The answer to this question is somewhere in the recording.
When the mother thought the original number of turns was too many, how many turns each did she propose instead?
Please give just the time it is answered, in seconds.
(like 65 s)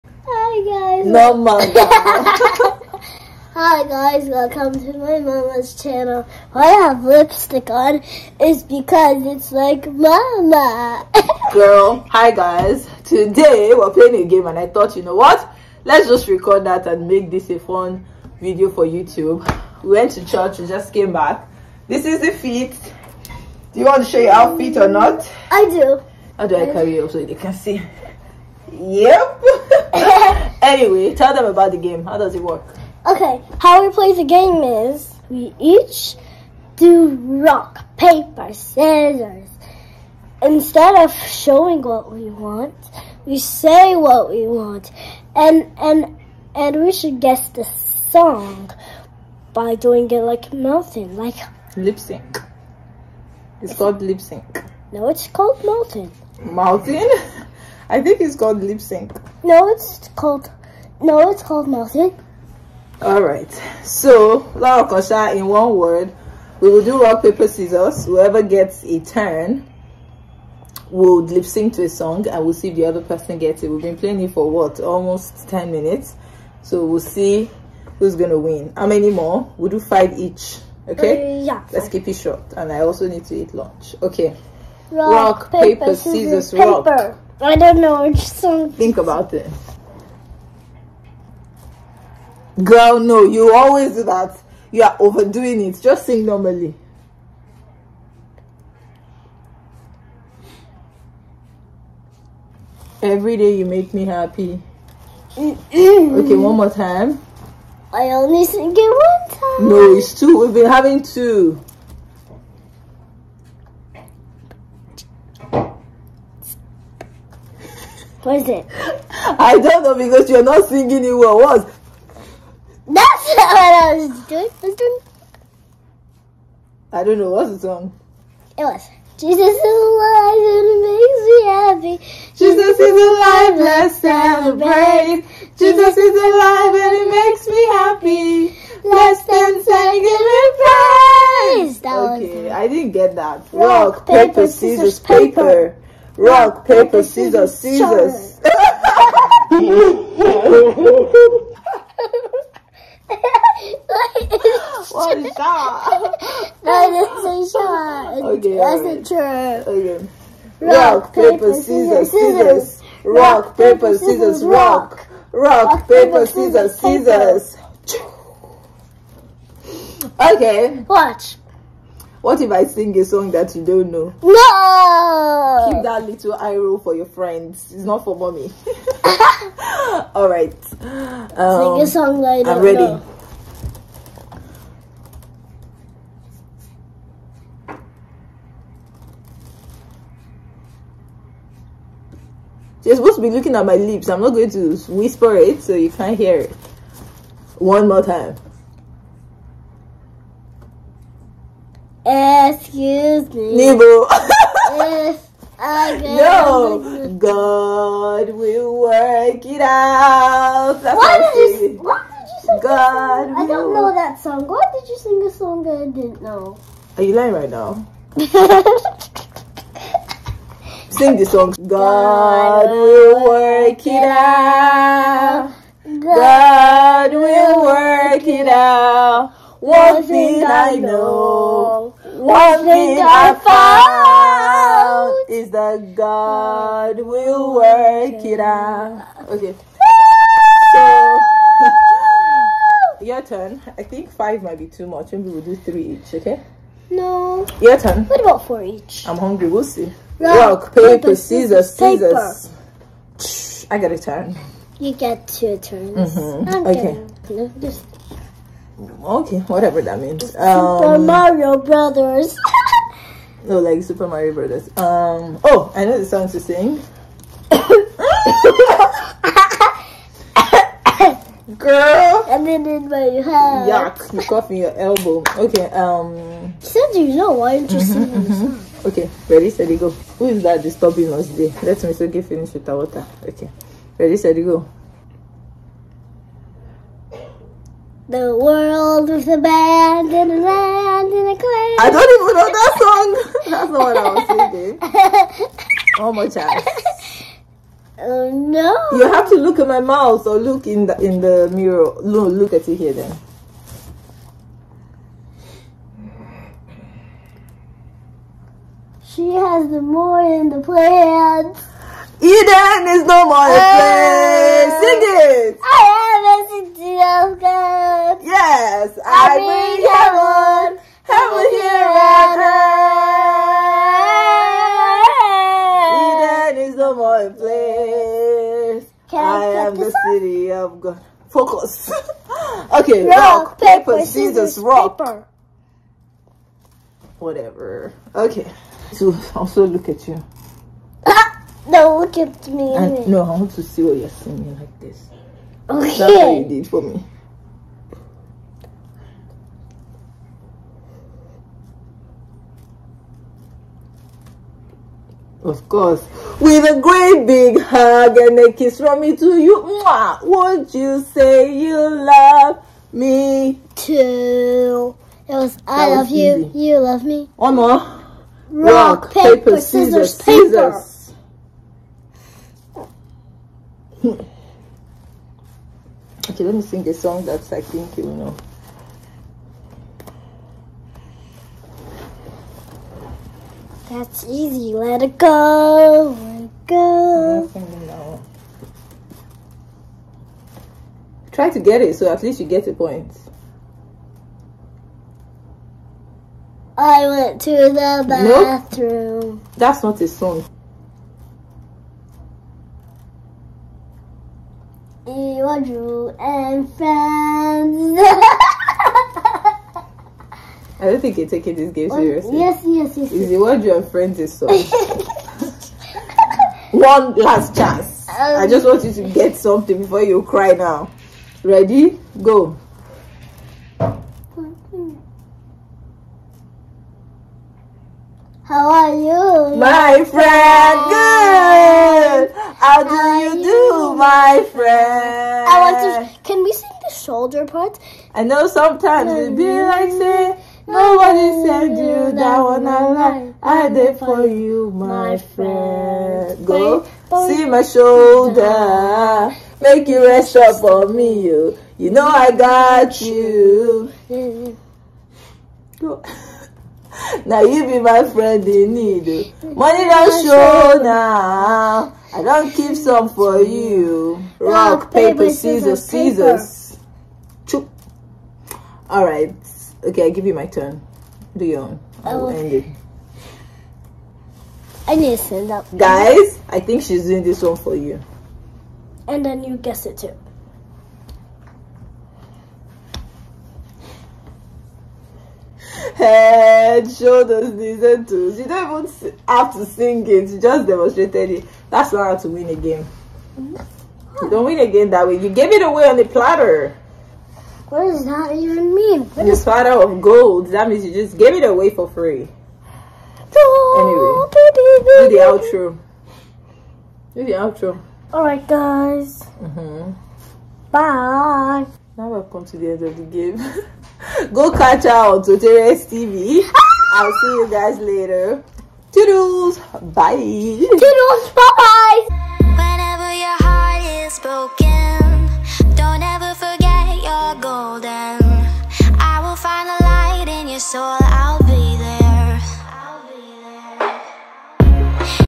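245 s.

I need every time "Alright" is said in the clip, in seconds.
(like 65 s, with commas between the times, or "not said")
179 s, 508 s.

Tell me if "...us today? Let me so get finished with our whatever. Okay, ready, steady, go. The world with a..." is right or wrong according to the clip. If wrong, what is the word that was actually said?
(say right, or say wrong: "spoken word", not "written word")
wrong: "water", not "whatever".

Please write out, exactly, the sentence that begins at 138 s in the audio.
Let's dance and give him praise.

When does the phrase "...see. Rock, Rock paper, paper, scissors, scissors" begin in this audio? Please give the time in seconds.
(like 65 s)
249 s.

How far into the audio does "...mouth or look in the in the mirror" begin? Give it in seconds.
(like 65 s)
299 s.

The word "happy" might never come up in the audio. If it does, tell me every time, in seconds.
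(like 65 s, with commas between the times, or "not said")
104 s, 131 s, 137 s.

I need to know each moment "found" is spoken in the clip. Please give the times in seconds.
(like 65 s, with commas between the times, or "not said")
233 s.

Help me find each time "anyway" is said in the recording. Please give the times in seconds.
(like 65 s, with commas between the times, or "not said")
30 s, 503 s.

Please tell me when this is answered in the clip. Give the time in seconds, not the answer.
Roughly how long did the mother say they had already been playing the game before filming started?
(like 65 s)
75 s.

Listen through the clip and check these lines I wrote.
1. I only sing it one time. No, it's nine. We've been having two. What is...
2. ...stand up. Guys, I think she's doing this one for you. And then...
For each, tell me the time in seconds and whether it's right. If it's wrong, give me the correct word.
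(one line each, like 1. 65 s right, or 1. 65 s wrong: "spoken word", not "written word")
1. 107 s wrong: "two", not "nine"
2. 475 s right.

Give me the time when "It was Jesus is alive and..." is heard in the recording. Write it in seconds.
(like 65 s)
128 s.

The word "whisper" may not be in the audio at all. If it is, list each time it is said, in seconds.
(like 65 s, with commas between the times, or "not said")
194 s.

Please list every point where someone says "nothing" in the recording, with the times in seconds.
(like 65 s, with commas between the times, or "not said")
61 s.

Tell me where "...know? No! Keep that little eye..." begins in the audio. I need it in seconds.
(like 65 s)
173 s.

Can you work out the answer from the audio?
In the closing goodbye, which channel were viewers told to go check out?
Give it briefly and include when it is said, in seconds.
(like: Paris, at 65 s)
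Soteria's TV, at 515 s.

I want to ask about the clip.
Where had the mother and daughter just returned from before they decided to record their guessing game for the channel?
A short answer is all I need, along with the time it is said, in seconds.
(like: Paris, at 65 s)
church, at 20 s.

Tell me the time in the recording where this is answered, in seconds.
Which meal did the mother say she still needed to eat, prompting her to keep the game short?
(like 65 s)
83 s.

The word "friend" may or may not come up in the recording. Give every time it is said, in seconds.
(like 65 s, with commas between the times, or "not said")
177 s, 406 s, 413 s, 430 s, 434 s, 445 s, 458 s.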